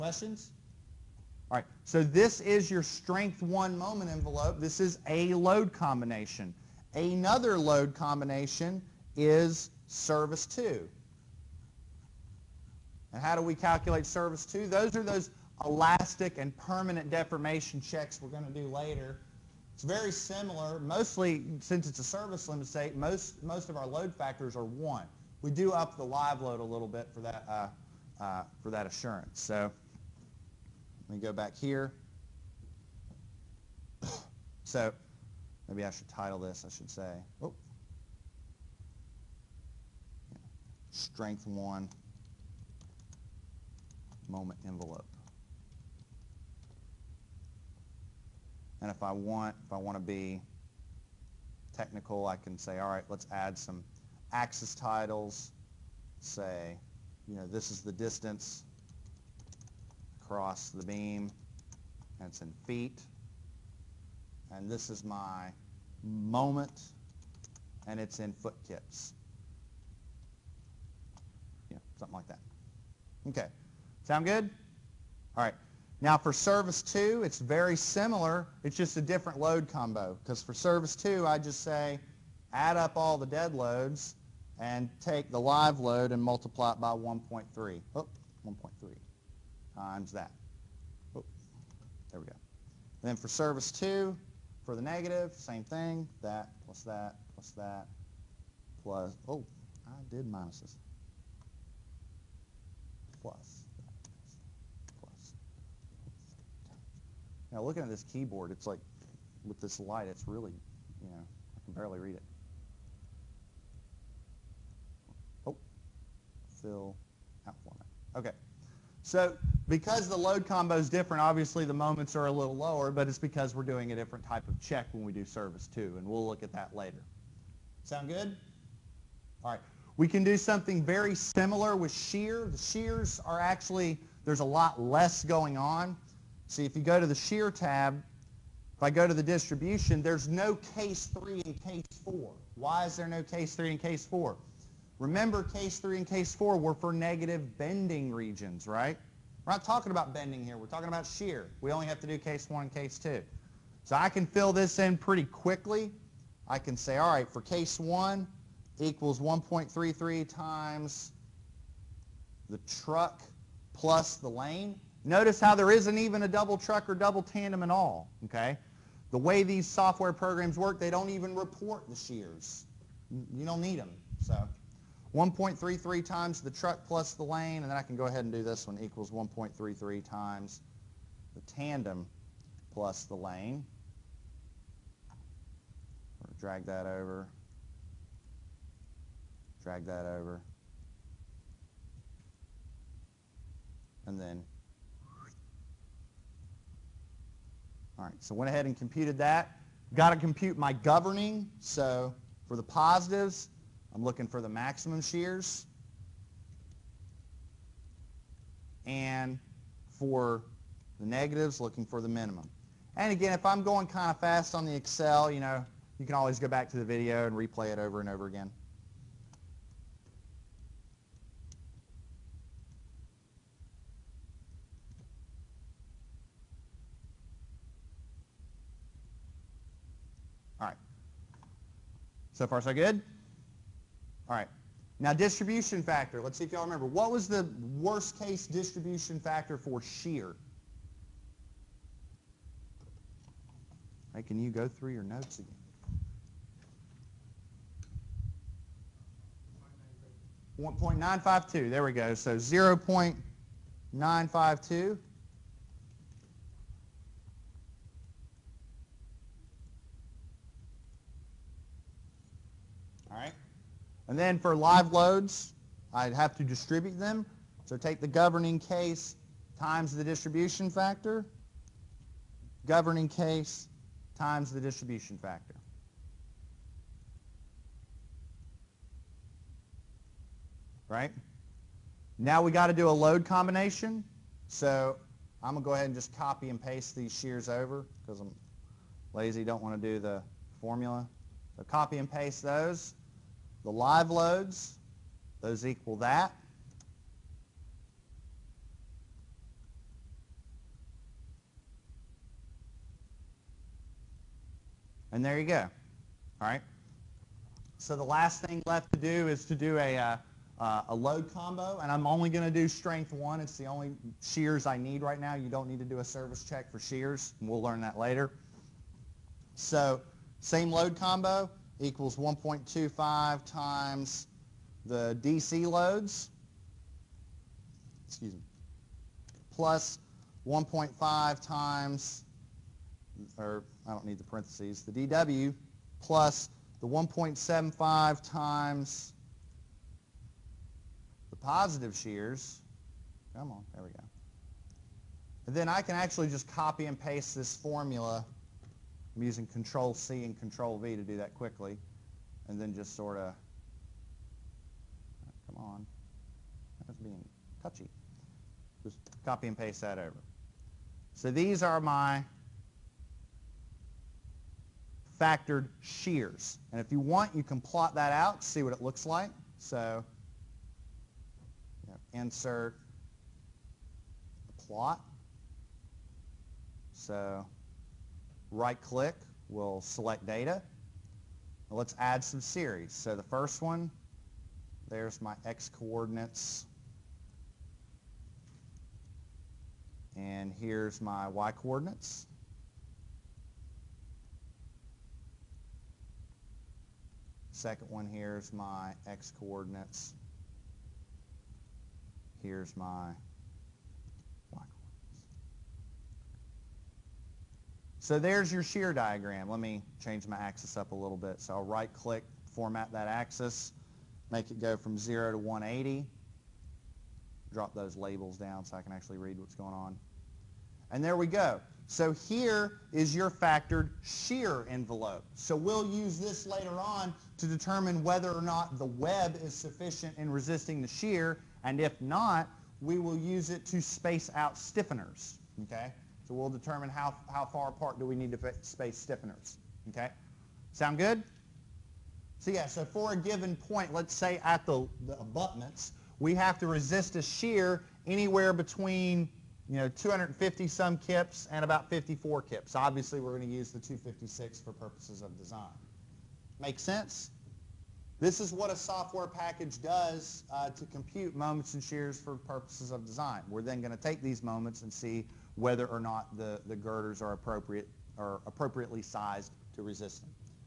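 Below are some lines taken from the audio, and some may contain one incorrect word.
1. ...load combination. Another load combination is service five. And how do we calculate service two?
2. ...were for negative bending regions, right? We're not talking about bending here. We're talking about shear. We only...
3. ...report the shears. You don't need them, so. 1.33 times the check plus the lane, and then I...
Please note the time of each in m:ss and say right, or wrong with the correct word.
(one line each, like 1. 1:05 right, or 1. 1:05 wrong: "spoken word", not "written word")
1. 0:05 wrong: "two", not "five"
2. 2:26 right
3. 2:51 wrong: "truck", not "check".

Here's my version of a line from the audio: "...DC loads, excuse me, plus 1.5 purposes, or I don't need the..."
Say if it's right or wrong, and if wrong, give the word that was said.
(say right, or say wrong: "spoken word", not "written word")
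wrong: "times", not "purposes".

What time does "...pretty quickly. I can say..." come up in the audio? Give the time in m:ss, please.
2:34.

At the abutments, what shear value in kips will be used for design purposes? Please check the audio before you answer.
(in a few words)
256.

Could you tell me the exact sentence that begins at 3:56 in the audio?
What was the worst case distribution factor for shear?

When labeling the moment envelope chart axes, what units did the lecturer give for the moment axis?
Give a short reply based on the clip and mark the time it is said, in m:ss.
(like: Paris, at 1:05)
foot kips, at 1:08.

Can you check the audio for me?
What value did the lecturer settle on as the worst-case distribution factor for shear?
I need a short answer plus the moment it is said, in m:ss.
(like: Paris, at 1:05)
0.952, at 4:12.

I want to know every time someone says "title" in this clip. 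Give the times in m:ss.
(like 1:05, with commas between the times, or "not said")
0:36, 0:54.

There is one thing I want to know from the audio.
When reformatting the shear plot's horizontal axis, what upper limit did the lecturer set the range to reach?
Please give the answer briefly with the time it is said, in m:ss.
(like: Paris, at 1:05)
180, at 6:55.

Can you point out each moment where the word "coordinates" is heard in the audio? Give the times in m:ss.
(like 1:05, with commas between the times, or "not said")
6:25, 6:31, 6:39.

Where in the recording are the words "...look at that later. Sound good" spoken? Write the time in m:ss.
2:06.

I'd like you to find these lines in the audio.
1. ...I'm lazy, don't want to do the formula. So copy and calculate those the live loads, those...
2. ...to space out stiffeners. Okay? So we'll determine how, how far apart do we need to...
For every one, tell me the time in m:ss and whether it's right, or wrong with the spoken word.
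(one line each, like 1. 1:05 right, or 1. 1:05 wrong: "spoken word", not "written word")
1. 4:48 wrong: "paste", not "calculate"
2. 7:13 right.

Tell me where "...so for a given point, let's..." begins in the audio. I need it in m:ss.
7:22.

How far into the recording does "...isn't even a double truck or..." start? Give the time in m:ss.
2:45.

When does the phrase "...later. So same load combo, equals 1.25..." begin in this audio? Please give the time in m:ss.
5:17.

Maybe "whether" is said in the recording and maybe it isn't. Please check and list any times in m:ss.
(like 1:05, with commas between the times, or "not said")
7:08, 7:45.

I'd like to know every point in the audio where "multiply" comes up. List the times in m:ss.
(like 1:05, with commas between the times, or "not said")
1:26.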